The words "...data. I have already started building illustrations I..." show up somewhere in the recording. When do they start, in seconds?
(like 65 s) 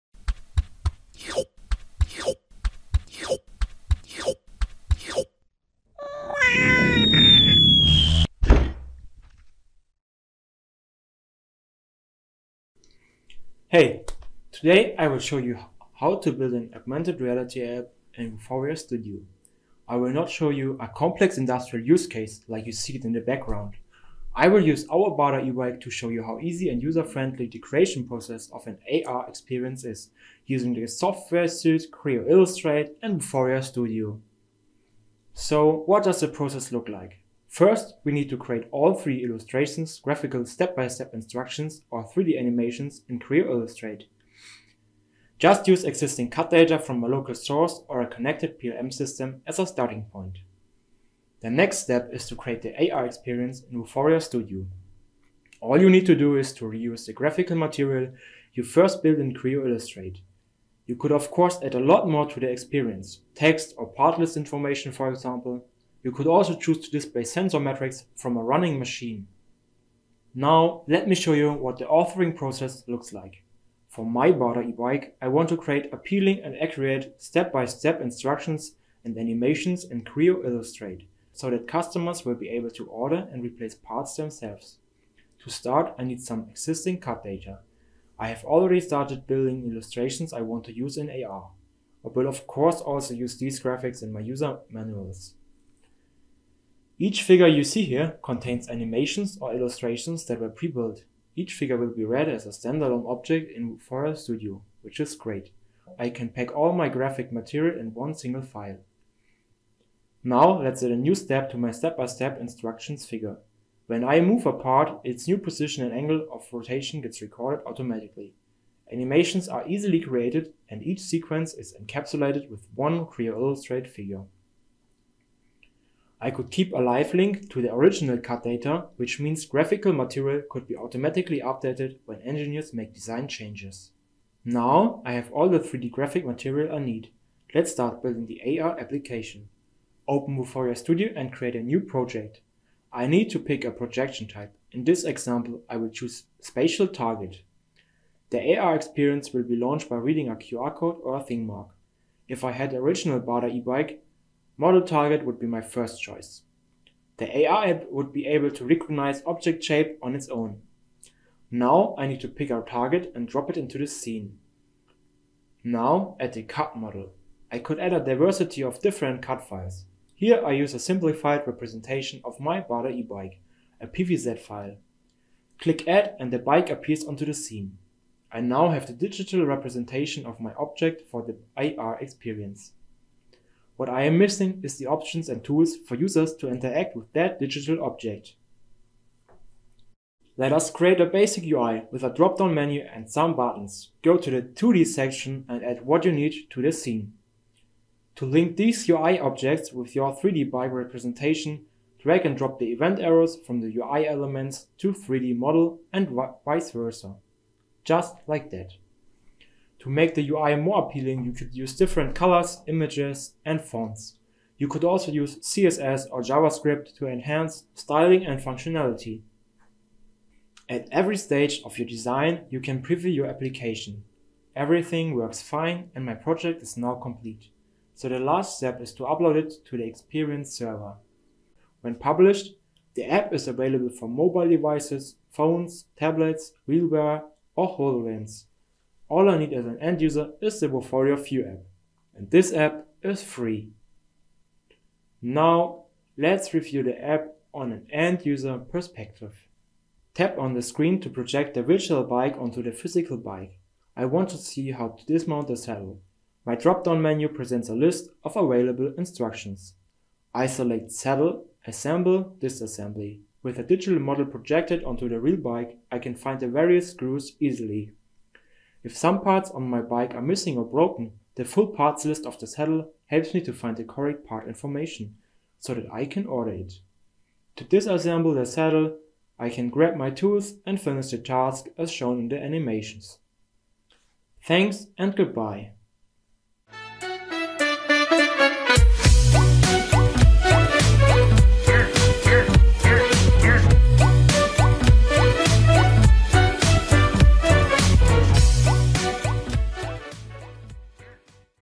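87 s.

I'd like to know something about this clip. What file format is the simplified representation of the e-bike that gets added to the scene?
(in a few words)
PVZ.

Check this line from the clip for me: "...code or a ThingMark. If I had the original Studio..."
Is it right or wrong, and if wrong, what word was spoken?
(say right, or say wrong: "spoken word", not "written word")
wrong: "Bada", not "Studio".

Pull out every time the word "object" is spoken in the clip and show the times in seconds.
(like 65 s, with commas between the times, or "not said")
103 s, 159 s, 180 s, 187 s, 199 s.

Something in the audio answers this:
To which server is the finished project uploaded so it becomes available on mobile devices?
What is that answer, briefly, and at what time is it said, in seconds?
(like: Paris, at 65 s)
Experience server, at 229 s.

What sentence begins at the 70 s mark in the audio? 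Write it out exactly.
Now let me show you what the authoring process looks like.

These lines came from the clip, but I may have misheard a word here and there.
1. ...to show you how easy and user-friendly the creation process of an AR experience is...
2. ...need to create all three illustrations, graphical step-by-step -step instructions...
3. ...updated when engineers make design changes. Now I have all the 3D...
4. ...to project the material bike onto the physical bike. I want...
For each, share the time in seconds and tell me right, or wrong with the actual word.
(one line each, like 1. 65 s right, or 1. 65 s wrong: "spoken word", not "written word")
1. 25 s right
2. 38 s right
3. 131 s right
4. 251 s wrong: "virtual", not "material".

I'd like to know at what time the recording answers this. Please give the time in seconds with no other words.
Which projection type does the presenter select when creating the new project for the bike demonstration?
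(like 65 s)
146 s.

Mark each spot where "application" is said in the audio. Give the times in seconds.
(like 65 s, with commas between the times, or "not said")
138 s, 223 s.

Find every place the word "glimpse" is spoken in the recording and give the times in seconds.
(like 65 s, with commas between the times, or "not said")
not said.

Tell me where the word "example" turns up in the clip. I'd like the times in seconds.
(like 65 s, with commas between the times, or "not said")
65 s, 145 s.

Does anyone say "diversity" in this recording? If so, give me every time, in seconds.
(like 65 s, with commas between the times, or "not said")
167 s.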